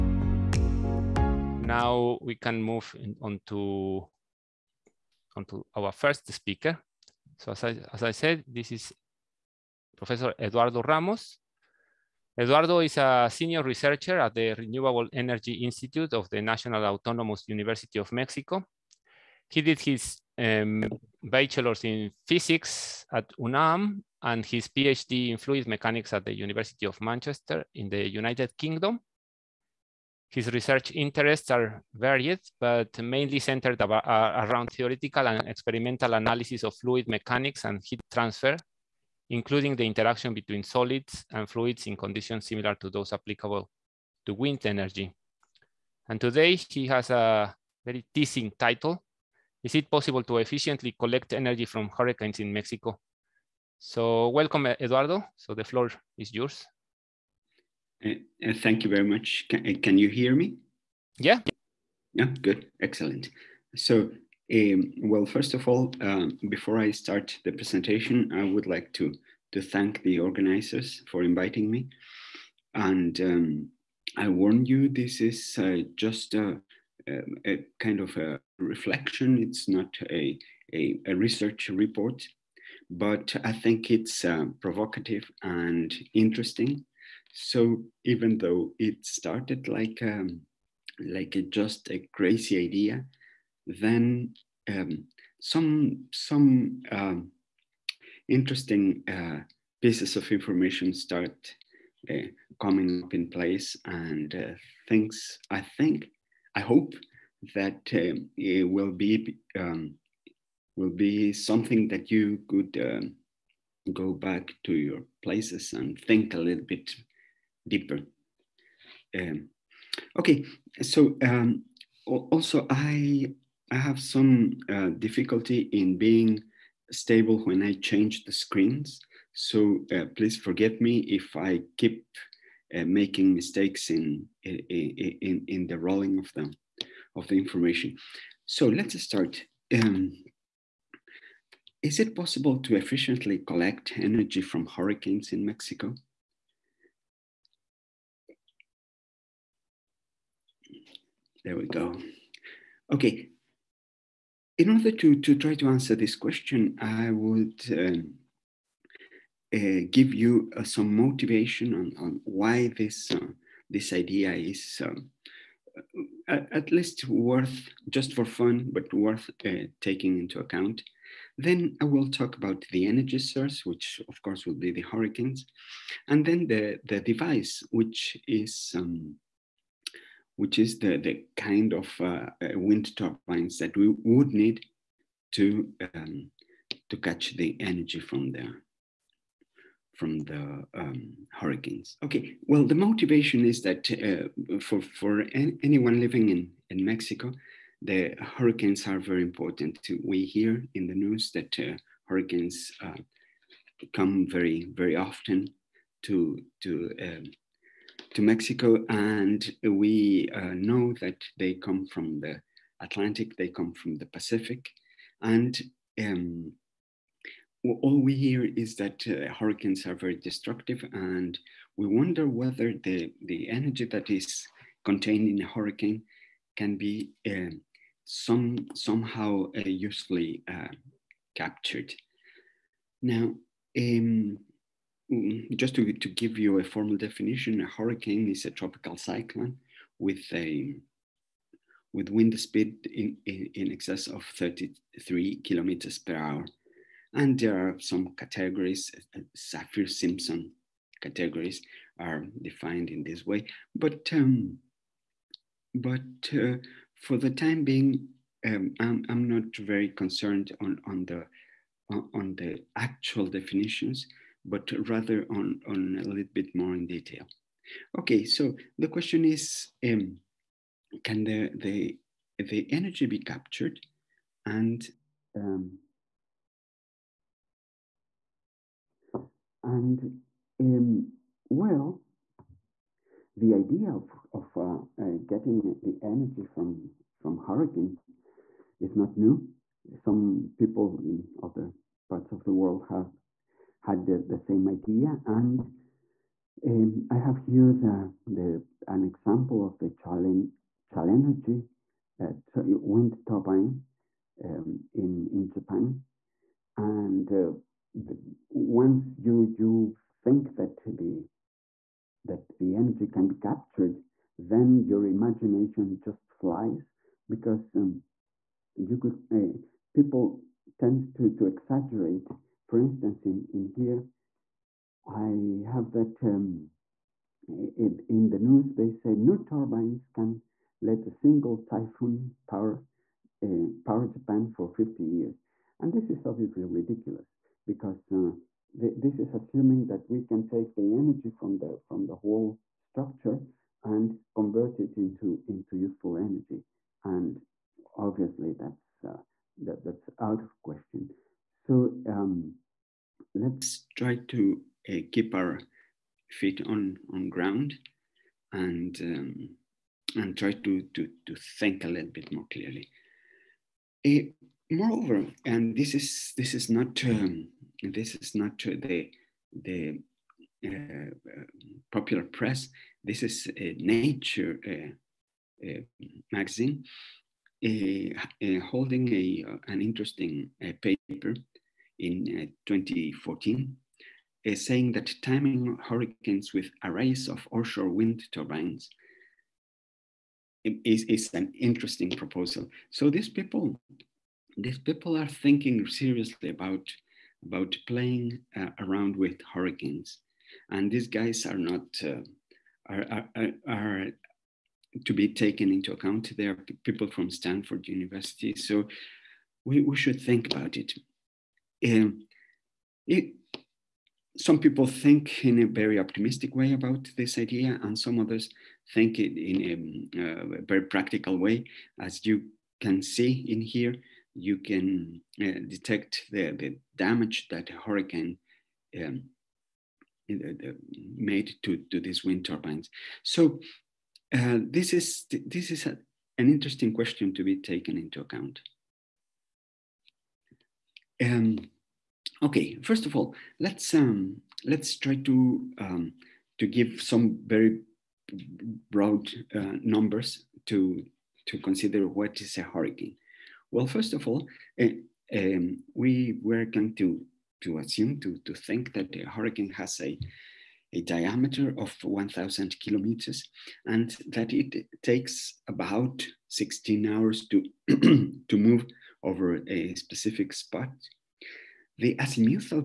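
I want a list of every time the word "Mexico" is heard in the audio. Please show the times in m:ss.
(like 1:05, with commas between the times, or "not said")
0:18, 0:52, 2:25, 3:16, 3:28.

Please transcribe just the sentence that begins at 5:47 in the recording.
And obviously that's, uh, that, that's out of question.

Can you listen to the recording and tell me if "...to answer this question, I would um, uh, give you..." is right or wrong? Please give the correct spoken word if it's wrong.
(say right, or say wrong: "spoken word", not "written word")
right.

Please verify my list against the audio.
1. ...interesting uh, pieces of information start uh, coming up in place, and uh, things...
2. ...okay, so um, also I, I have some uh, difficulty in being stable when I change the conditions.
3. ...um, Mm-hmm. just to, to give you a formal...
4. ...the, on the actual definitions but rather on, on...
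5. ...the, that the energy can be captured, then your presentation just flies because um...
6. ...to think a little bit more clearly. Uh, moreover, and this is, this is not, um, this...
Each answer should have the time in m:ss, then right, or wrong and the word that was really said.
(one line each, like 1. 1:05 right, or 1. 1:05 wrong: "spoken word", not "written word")
1. 1:38 right
2. 2:00 wrong: "screens", not "conditions"
3. 3:53 right
4. 4:21 right
5. 5:10 wrong: "imagination", not "presentation"
6. 6:01 right.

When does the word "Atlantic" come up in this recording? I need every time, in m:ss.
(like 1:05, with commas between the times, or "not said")
3:32.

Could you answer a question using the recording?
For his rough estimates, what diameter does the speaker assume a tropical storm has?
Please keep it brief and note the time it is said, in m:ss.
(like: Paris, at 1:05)
1,000 kilometers, at 7:42.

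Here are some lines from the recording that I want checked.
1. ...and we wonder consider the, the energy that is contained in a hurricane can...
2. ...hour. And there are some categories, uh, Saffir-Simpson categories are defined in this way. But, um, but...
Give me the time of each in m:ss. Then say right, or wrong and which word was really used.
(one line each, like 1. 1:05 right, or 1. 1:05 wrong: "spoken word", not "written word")
1. 3:40 wrong: "whether", not "consider"
2. 4:06 right.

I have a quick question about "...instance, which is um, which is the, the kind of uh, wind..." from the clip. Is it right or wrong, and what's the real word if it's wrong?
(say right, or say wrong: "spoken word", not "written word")
wrong: "device", not "instance".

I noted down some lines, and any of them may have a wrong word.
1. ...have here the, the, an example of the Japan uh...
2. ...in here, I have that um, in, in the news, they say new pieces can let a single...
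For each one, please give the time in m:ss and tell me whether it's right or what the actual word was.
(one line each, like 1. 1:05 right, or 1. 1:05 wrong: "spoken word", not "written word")
1. 4:57 wrong: "Challenergy", not "Japan"
2. 5:23 wrong: "turbines", not "pieces".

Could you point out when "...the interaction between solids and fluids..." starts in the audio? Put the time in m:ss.
0:39.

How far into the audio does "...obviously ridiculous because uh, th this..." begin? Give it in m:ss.
5:36.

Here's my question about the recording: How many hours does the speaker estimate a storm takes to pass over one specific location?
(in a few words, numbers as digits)
16 hours.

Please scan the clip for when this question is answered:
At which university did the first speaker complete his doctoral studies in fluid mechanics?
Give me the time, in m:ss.
0:26.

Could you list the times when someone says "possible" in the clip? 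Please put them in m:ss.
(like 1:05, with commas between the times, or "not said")
0:49, 2:22.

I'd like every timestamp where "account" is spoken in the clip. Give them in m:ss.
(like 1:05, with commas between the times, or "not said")
2:50, 6:45, 7:18.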